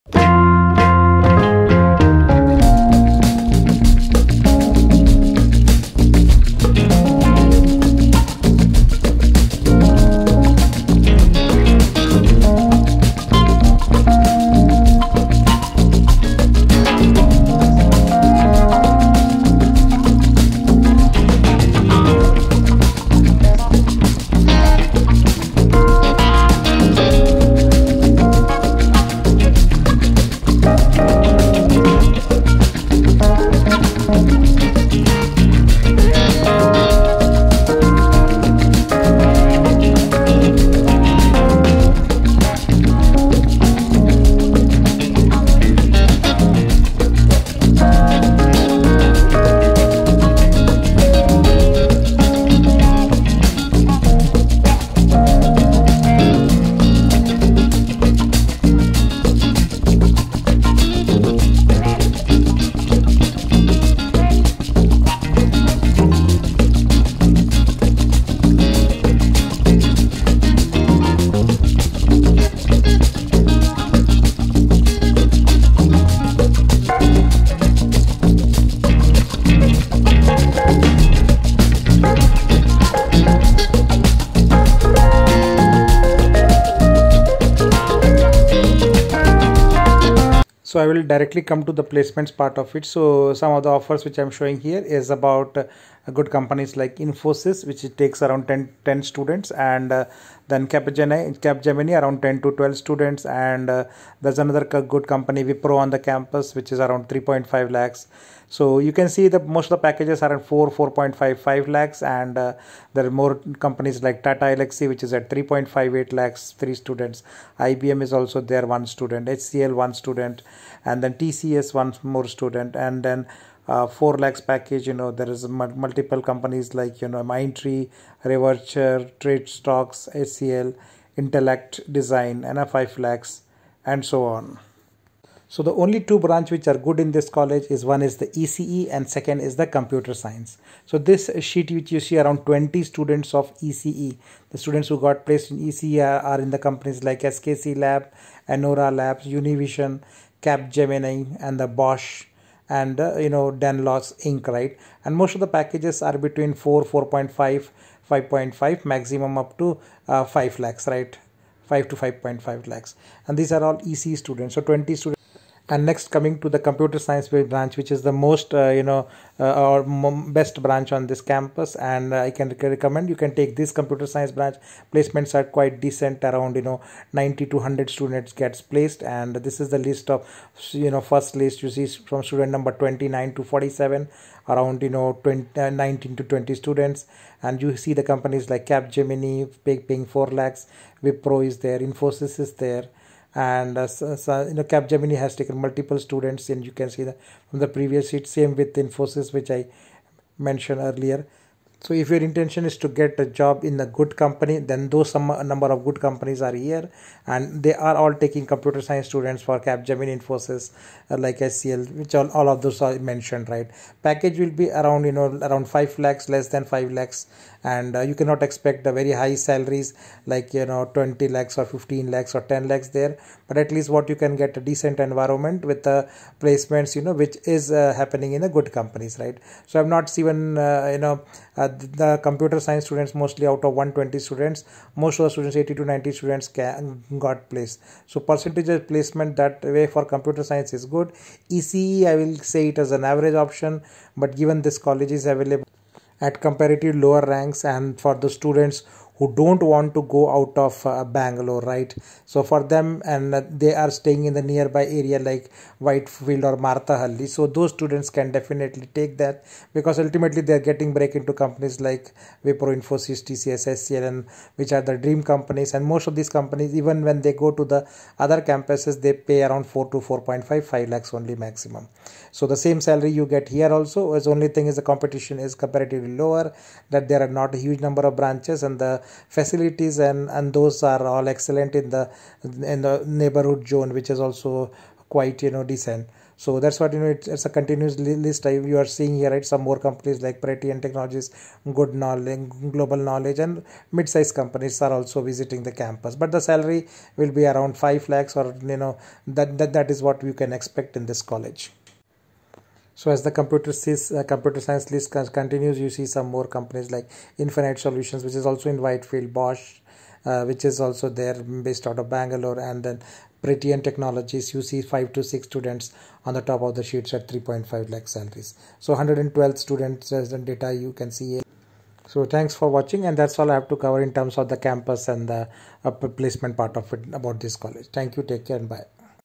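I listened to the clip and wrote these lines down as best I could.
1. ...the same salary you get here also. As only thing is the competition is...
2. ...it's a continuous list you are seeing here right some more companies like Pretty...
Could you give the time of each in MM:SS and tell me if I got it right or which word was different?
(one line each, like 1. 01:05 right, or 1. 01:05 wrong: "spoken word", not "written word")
1. 04:32 right
2. 04:47 right.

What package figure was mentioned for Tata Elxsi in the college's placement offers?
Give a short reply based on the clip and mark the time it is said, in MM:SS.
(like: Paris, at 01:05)
3.58 lakhs, at 01:55.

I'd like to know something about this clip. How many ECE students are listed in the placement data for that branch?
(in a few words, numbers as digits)
20.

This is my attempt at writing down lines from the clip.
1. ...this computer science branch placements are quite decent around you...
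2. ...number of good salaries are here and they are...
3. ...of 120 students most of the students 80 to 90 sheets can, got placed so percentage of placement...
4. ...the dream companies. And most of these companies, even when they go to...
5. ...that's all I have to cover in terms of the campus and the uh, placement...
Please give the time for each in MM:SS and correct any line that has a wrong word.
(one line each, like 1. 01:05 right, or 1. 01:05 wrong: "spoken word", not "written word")
1. 02:53 right
2. 03:25 wrong: "companies", not "salaries"
3. 03:53 wrong: "students", not "sheets"
4. 04:24 right
5. 05:23 right.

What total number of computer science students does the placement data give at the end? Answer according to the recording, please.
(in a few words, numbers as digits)
112.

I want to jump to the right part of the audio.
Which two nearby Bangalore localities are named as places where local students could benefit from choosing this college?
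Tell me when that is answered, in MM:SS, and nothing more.
04:15.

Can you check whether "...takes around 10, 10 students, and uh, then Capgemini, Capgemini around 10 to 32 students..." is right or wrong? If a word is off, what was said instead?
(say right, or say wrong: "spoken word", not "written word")
wrong: "12", not "32".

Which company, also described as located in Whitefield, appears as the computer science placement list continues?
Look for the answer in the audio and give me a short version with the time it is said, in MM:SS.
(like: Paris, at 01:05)
Infinite Solutions, at 05:07.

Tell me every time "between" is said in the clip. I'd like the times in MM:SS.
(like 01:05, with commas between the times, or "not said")
02:36.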